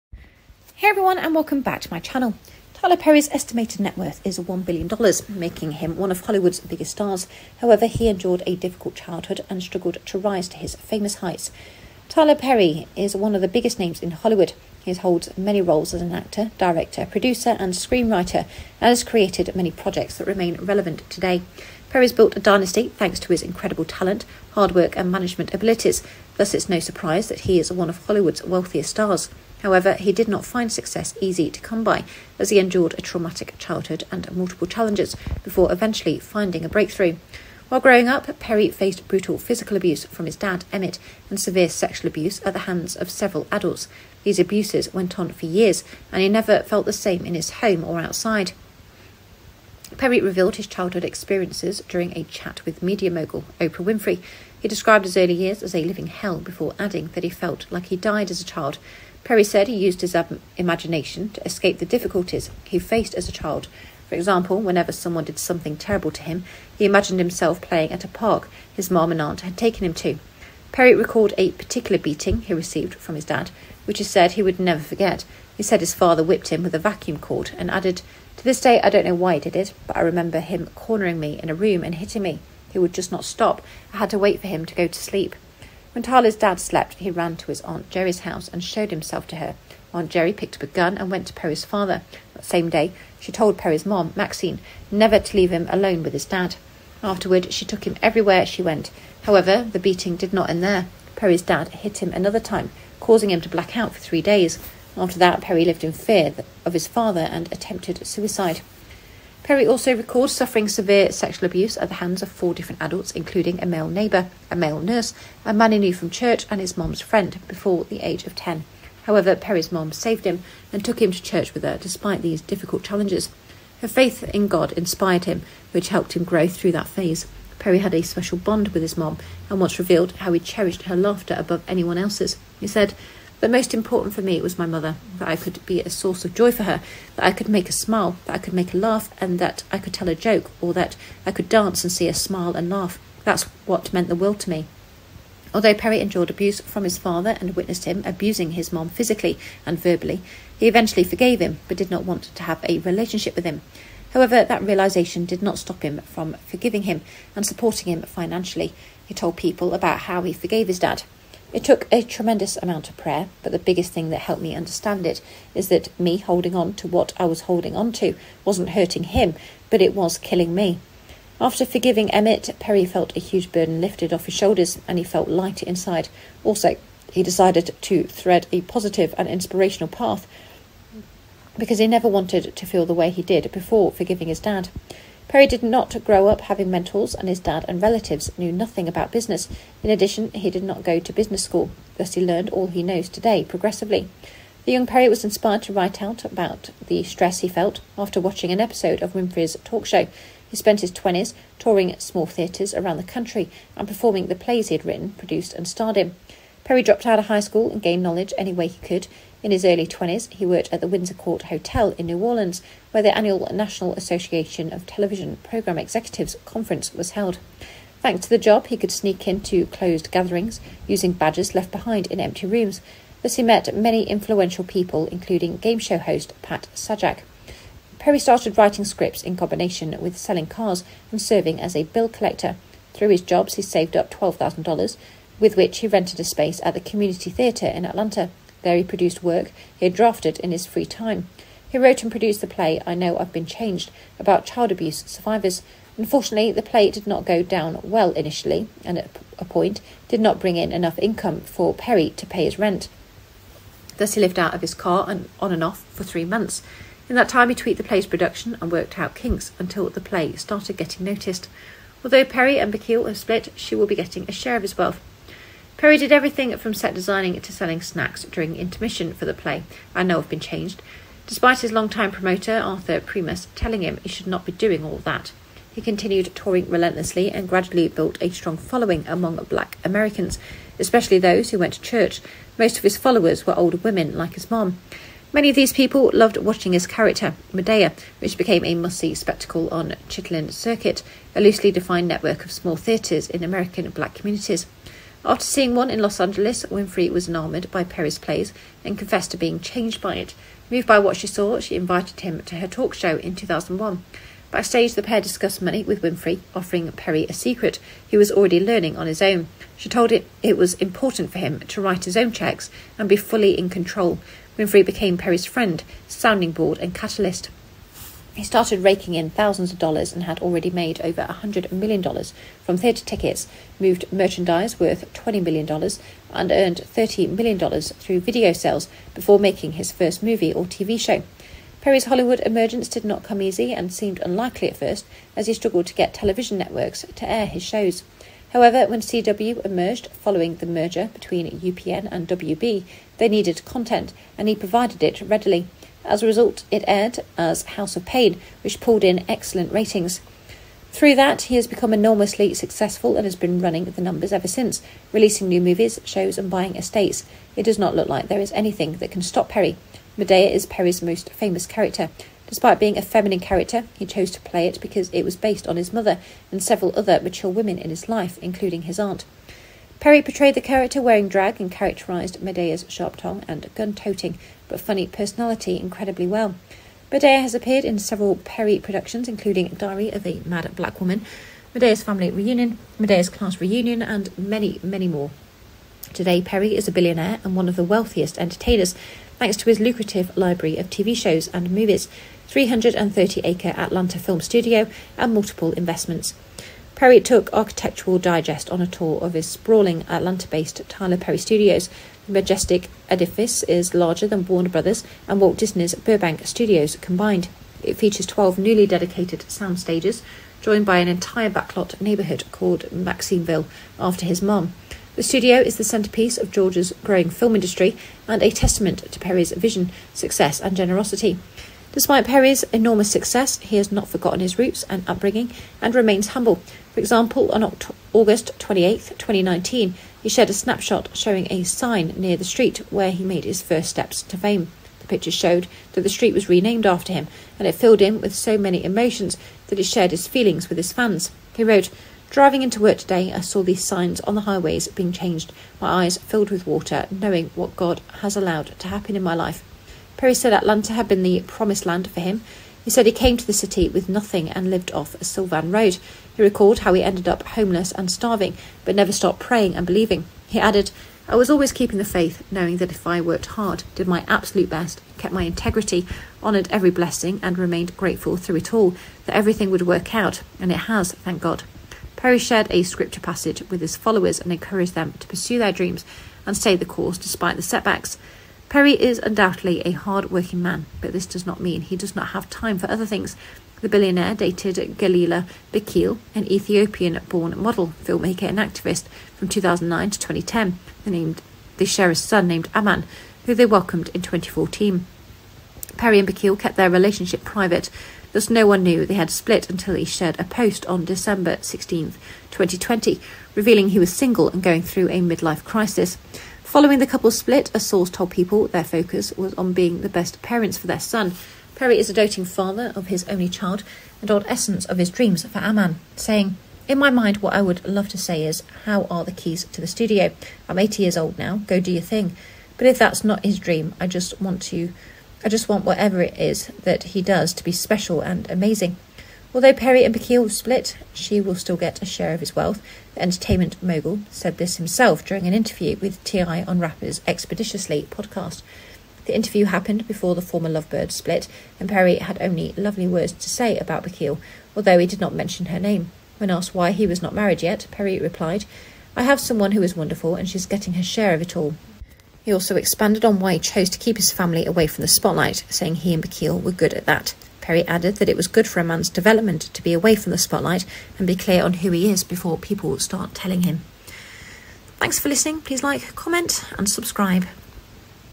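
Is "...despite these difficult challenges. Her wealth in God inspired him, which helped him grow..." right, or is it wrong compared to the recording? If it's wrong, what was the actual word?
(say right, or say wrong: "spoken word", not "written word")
wrong: "faith", not "wealth".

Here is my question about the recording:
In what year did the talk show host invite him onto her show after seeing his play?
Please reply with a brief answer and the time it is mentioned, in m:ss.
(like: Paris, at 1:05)
2001, at 5:03.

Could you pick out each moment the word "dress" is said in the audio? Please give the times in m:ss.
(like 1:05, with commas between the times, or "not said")
not said.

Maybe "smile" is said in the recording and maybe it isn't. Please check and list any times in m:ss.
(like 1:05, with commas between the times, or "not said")
2:17, 2:22.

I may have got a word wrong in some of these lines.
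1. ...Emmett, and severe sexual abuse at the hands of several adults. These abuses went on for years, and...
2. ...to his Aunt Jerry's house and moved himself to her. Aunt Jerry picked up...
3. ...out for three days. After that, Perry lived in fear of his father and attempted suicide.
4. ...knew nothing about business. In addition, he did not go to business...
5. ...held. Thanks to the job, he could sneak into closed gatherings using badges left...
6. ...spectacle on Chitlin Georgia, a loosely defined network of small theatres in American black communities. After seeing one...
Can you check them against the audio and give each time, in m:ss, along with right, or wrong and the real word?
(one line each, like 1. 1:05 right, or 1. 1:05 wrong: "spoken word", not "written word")
1. 0:40 right
2. 1:27 wrong: "showed", not "moved"
3. 1:43 right
4. 3:08 right
5. 3:37 right
6. 4:49 wrong: "Circuit", not "Georgia".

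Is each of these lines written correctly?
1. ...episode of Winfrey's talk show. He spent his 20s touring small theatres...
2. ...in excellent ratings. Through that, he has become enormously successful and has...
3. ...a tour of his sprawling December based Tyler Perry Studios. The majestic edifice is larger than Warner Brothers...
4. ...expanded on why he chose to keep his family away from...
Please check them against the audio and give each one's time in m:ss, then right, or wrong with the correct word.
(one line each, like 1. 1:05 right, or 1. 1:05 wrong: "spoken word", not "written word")
1. 3:18 right
2. 5:49 right
3. 6:38 wrong: "Atlanta", not "December"
4. 9:12 right.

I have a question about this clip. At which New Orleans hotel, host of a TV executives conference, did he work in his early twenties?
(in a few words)
Windsor Court Hotel.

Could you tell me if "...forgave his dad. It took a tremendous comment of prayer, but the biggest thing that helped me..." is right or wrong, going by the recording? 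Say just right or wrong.
wrong.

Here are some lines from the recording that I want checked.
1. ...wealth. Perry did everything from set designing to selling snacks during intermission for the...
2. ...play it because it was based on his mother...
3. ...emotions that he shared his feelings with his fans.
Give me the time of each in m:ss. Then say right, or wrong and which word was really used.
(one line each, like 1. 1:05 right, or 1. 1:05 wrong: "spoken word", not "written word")
1. 4:24 right
2. 6:04 right
3. 7:18 right.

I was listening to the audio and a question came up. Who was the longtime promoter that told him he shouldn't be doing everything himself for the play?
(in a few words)
Arthur Primus.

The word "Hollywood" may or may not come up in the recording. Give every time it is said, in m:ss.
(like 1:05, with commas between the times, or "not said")
0:06, 0:14, 0:28, 5:32.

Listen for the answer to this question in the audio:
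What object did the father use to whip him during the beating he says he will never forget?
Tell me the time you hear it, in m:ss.
1:16.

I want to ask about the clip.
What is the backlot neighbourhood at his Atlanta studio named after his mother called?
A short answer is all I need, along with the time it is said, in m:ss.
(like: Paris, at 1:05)
Maxineville, at 6:52.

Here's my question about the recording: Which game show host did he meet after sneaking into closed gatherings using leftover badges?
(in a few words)
Pat Sajak.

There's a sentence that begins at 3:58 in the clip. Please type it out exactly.
There he produced work he had drafted in his free time.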